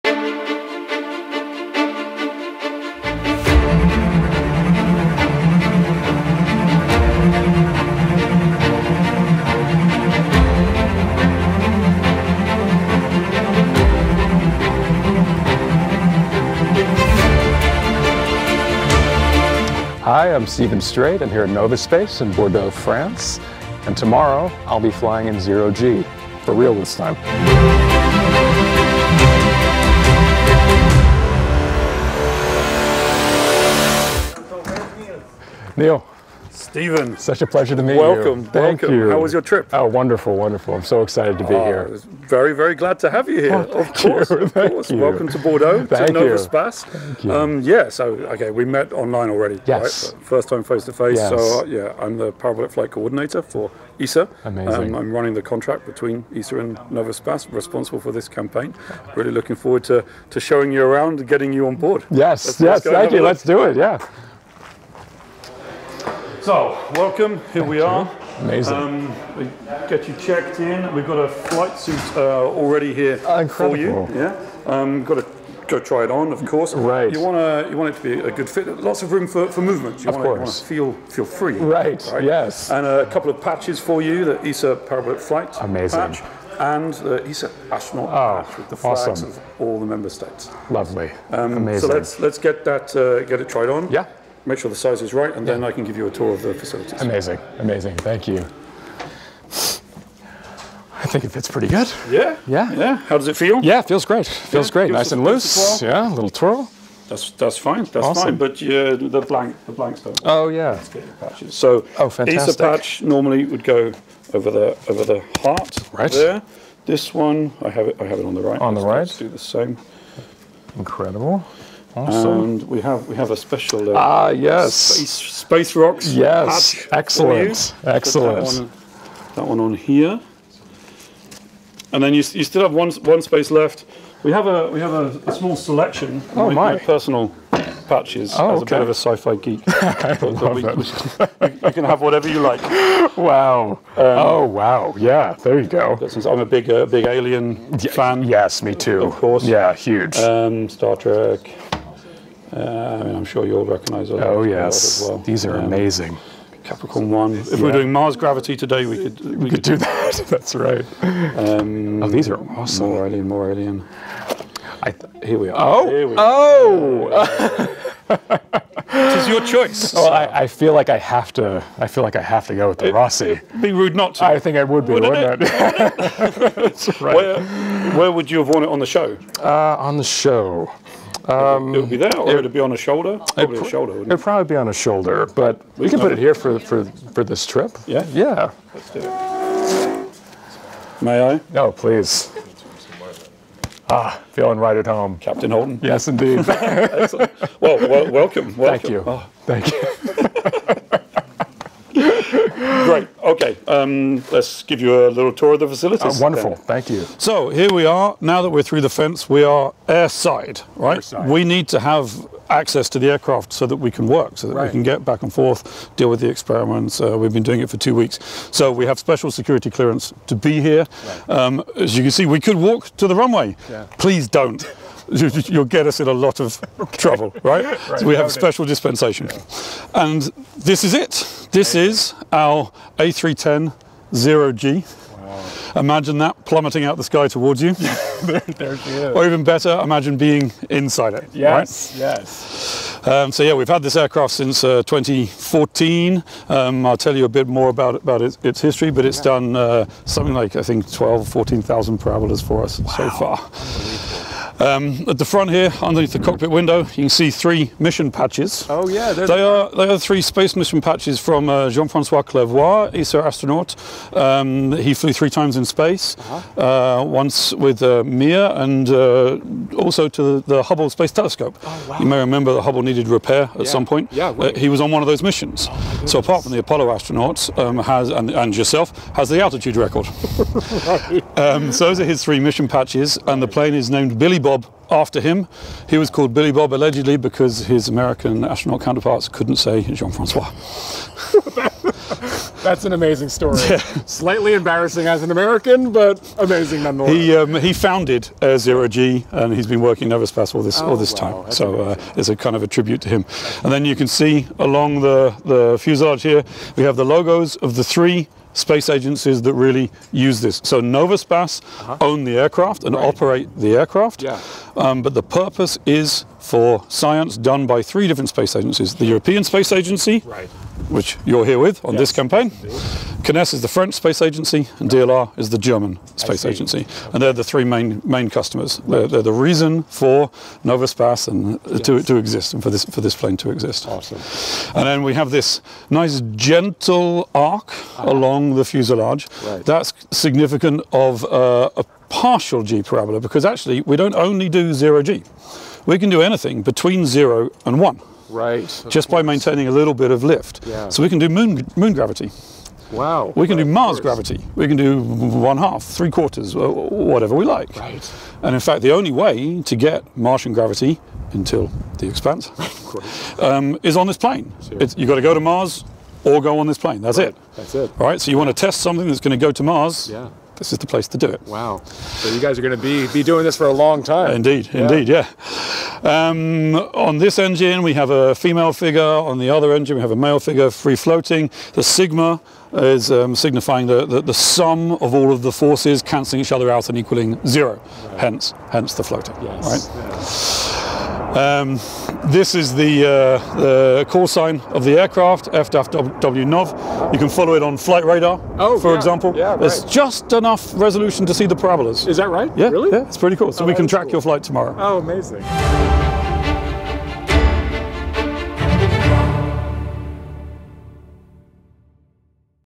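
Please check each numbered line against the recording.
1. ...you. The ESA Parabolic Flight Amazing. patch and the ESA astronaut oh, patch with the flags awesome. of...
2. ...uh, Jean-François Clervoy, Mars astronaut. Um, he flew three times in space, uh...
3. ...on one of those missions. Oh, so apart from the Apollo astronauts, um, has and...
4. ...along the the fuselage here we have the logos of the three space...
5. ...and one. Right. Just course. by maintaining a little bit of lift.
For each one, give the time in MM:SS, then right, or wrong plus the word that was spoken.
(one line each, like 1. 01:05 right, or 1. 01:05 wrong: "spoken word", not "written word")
1. 01:24 right
2. 04:21 wrong: "ESA", not "Mars"
3. 04:34 right
4. 05:04 right
5. 05:47 right.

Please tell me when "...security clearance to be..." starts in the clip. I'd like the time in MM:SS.
03:39.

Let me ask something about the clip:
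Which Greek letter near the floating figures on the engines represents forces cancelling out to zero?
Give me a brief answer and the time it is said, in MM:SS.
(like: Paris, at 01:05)
Sigma, at 06:21.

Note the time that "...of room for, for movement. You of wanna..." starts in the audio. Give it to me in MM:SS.
01:19.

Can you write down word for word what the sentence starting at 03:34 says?
we can get back and forth, deal with the experiments.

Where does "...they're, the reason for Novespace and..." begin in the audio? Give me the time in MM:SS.
05:29.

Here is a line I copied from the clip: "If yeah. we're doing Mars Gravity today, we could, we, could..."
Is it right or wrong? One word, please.
right.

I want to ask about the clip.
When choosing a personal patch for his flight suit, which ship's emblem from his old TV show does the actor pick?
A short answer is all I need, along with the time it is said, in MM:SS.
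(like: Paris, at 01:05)
Roci, at 02:52.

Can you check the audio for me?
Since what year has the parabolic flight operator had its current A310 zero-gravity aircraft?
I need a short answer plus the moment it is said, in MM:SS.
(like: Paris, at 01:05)
2014, at 04:04.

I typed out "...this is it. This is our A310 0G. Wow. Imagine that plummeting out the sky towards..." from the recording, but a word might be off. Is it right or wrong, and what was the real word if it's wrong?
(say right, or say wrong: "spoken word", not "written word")
right.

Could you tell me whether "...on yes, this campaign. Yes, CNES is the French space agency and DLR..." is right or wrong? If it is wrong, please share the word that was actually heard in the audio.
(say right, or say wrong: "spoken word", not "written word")
right.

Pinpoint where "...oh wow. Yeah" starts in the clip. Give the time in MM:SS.
02:23.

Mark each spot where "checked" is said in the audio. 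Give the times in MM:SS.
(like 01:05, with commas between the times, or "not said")
01:10.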